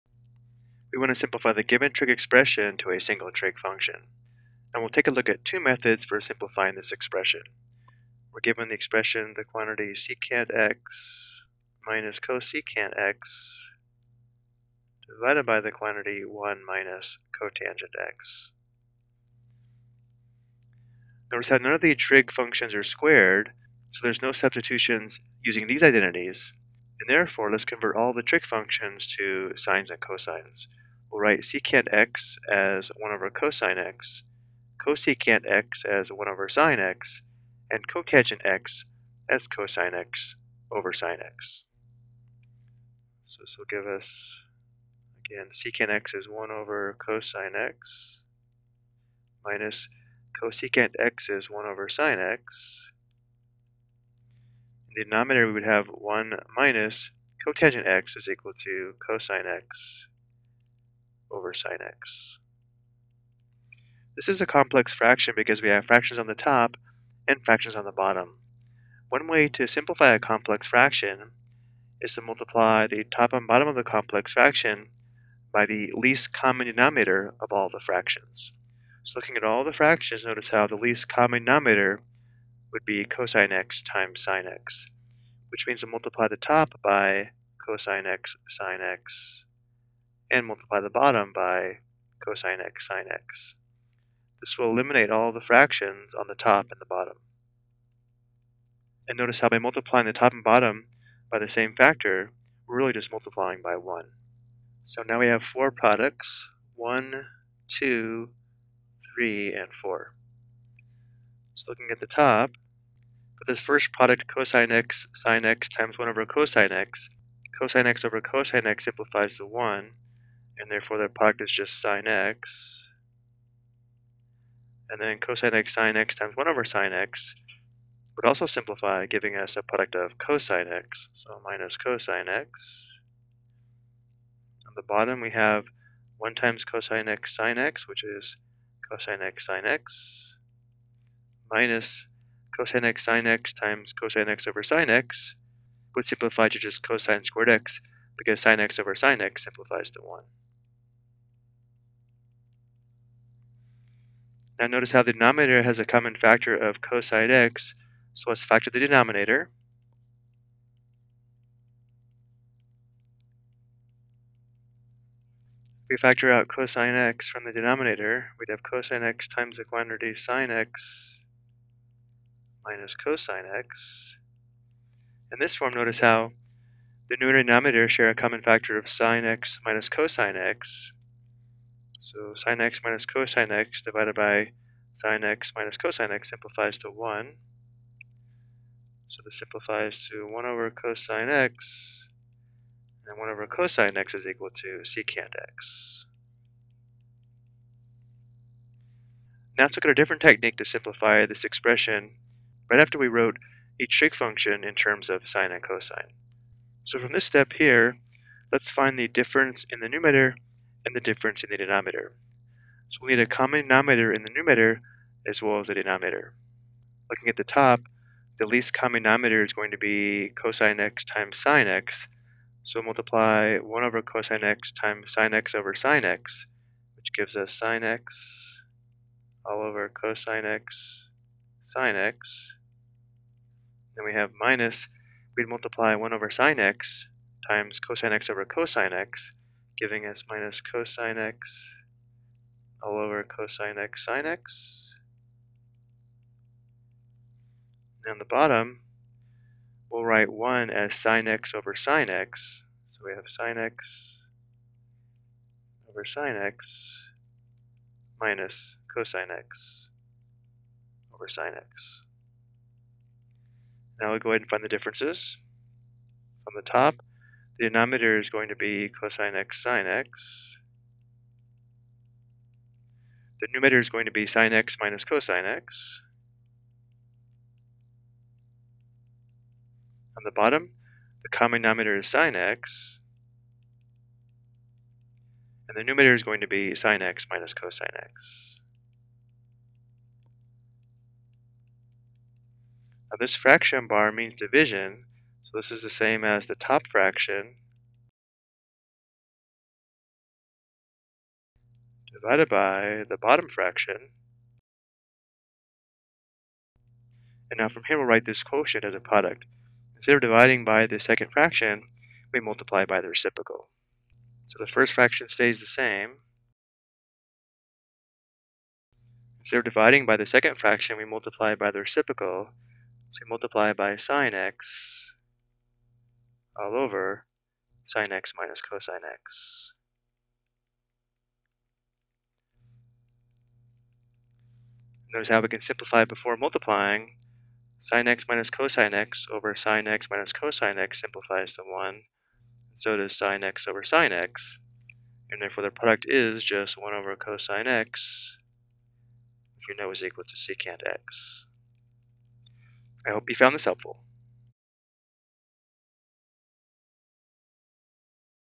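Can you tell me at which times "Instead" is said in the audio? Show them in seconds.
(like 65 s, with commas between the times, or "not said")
309 s, 319 s.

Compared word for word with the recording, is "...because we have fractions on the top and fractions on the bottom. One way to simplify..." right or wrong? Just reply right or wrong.
right.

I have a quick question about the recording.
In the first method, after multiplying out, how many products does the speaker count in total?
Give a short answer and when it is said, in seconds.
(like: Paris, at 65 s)
4, at 105 s.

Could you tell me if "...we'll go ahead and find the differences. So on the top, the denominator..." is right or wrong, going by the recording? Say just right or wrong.
right.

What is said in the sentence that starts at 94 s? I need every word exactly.
This will eliminate all the fractions on the top and the bottom.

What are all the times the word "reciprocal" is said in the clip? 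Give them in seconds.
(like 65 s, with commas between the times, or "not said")
313 s, 321 s.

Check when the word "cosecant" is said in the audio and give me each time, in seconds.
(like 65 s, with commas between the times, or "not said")
12 s, 34 s, 50 s.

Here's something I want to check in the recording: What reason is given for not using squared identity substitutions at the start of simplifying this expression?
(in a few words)
none of the trig functions are squared.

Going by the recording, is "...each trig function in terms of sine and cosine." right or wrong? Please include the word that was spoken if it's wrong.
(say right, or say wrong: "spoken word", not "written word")
right.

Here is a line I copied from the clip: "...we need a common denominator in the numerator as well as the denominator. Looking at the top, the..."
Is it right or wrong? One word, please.
right.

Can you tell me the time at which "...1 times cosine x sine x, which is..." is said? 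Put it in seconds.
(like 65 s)
136 s.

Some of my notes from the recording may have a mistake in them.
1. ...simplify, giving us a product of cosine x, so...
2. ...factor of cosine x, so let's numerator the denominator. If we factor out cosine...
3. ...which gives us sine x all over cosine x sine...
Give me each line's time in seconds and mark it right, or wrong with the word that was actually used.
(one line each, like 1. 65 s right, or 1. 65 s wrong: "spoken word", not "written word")
1. 128 s right
2. 156 s wrong: "factor", not "numerator"
3. 226 s right.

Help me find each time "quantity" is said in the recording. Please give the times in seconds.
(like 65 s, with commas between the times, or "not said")
9 s, 15 s, 169 s.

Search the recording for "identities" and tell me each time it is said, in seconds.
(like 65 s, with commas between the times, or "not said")
25 s.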